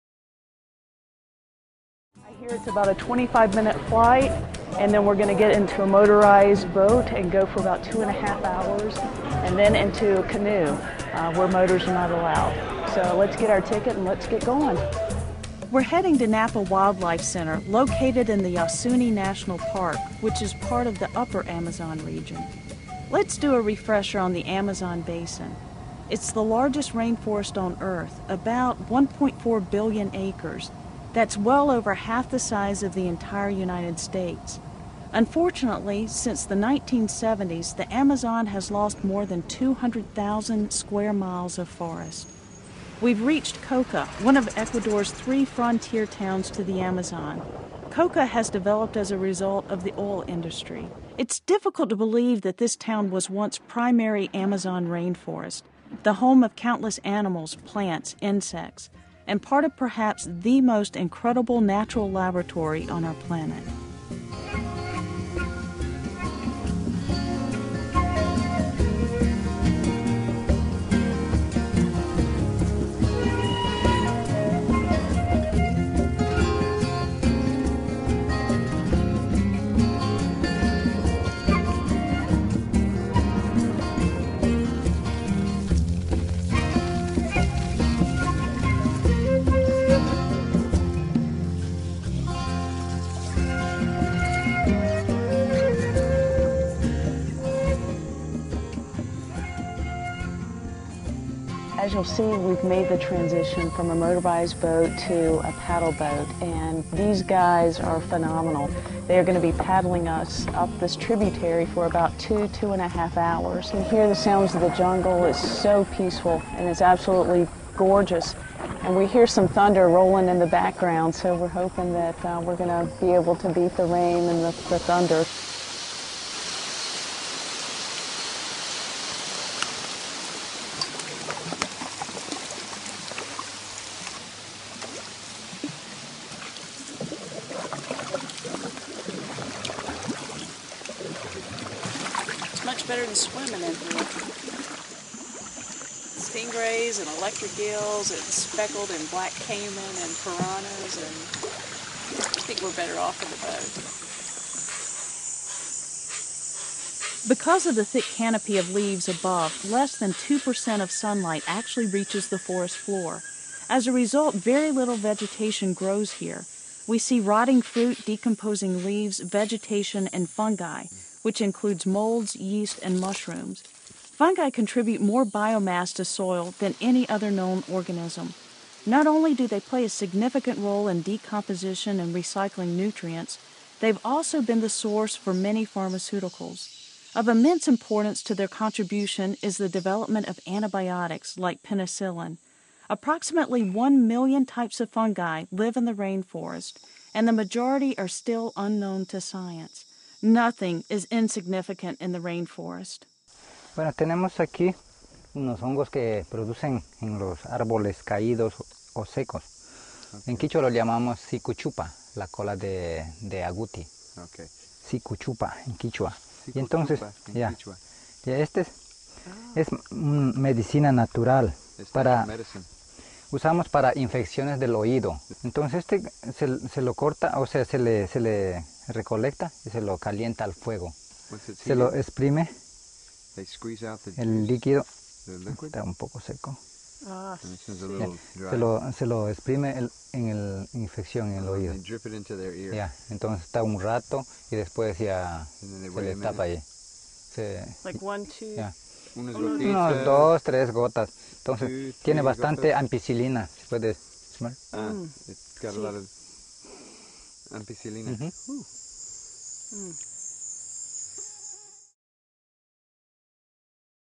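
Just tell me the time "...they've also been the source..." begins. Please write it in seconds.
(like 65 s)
183 s.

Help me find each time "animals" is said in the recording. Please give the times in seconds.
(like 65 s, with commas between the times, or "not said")
56 s.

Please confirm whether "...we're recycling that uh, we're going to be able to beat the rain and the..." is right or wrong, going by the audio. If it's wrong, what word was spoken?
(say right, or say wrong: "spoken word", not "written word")
wrong: "hoping", not "recycling".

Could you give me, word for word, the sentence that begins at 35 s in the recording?
Unfortunately, since the 1970s, the Amazon has lost more than 200,000 square miles of forest.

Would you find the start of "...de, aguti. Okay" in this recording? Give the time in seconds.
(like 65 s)
212 s.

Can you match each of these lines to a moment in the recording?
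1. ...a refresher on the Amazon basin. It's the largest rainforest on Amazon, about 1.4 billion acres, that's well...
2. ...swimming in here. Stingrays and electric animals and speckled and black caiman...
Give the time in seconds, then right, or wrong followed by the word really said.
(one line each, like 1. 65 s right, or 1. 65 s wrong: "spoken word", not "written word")
1. 23 s wrong: "Earth", not "Amazon"
2. 143 s wrong: "gills", not "animals".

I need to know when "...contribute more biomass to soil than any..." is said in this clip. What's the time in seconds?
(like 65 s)
174 s.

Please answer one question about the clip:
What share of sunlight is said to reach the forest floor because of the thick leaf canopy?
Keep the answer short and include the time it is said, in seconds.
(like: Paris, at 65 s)
less than 2%, at 159 s.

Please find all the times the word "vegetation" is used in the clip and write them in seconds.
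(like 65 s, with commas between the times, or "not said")
164 s, 169 s.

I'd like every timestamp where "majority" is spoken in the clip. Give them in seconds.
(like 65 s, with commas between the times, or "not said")
197 s.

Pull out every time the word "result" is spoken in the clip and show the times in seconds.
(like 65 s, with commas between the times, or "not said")
49 s, 163 s.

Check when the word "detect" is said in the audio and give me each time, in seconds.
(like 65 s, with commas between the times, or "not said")
not said.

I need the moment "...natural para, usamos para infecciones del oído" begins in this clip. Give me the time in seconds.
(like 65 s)
220 s.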